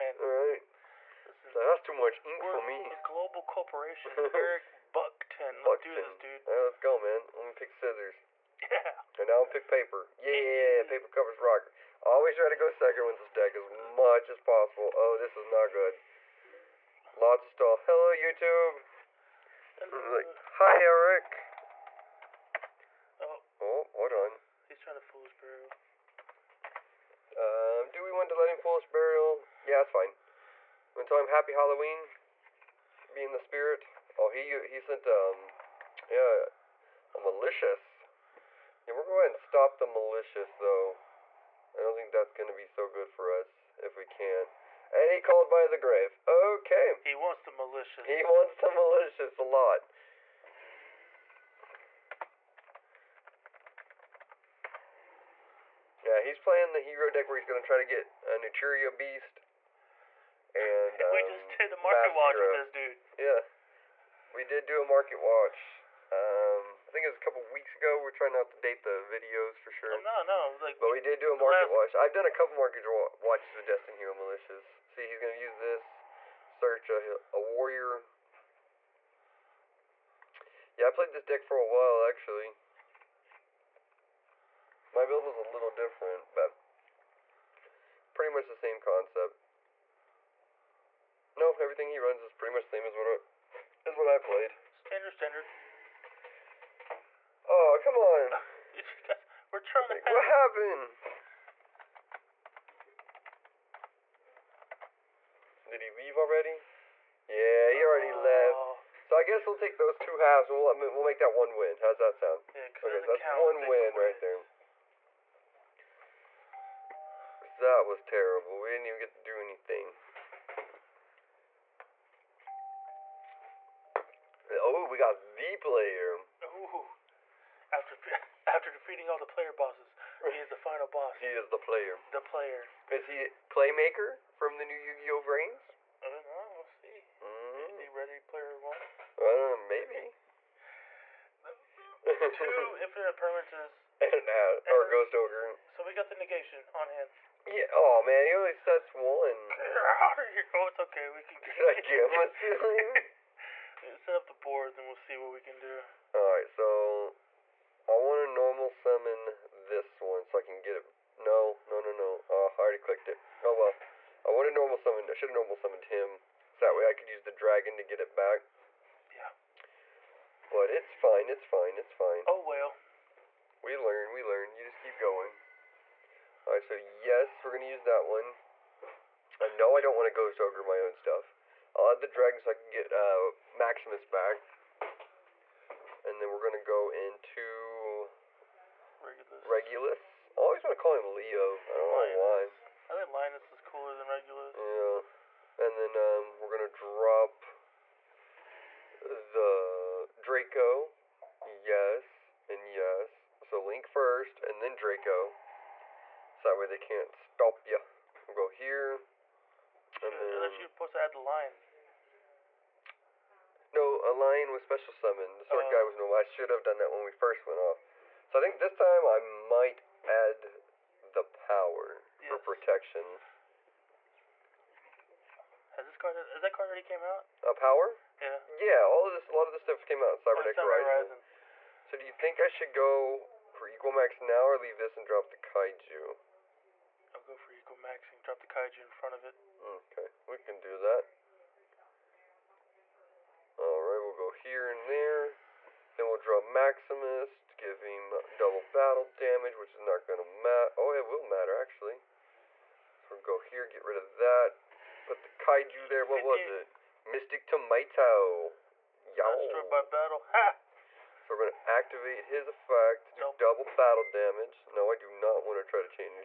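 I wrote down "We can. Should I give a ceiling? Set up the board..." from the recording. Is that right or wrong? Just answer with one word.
right.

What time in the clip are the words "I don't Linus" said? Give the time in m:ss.
3:11.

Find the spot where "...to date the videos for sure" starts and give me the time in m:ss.
1:08.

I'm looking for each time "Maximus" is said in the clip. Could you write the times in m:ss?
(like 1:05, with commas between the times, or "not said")
3:03, 4:06.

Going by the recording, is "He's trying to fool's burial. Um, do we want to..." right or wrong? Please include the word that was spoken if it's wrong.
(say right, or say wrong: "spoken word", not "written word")
right.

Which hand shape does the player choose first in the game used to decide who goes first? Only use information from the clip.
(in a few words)
Scissors.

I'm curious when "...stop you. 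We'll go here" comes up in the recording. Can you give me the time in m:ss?
3:27.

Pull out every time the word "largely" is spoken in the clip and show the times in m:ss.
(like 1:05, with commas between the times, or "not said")
not said.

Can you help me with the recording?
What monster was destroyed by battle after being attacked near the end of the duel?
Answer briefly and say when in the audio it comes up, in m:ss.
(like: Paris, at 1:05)
Mystic Tomato, at 4:17.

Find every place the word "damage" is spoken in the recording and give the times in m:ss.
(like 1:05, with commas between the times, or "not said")
4:09, 4:24.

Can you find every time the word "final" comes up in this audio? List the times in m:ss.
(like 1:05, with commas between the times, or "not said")
2:10.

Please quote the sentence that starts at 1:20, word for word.
Yeah, I played this deck for a while actually.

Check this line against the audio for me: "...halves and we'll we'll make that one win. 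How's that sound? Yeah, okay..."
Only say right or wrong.
right.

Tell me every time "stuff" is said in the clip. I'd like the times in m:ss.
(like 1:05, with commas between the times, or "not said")
3:00, 3:49.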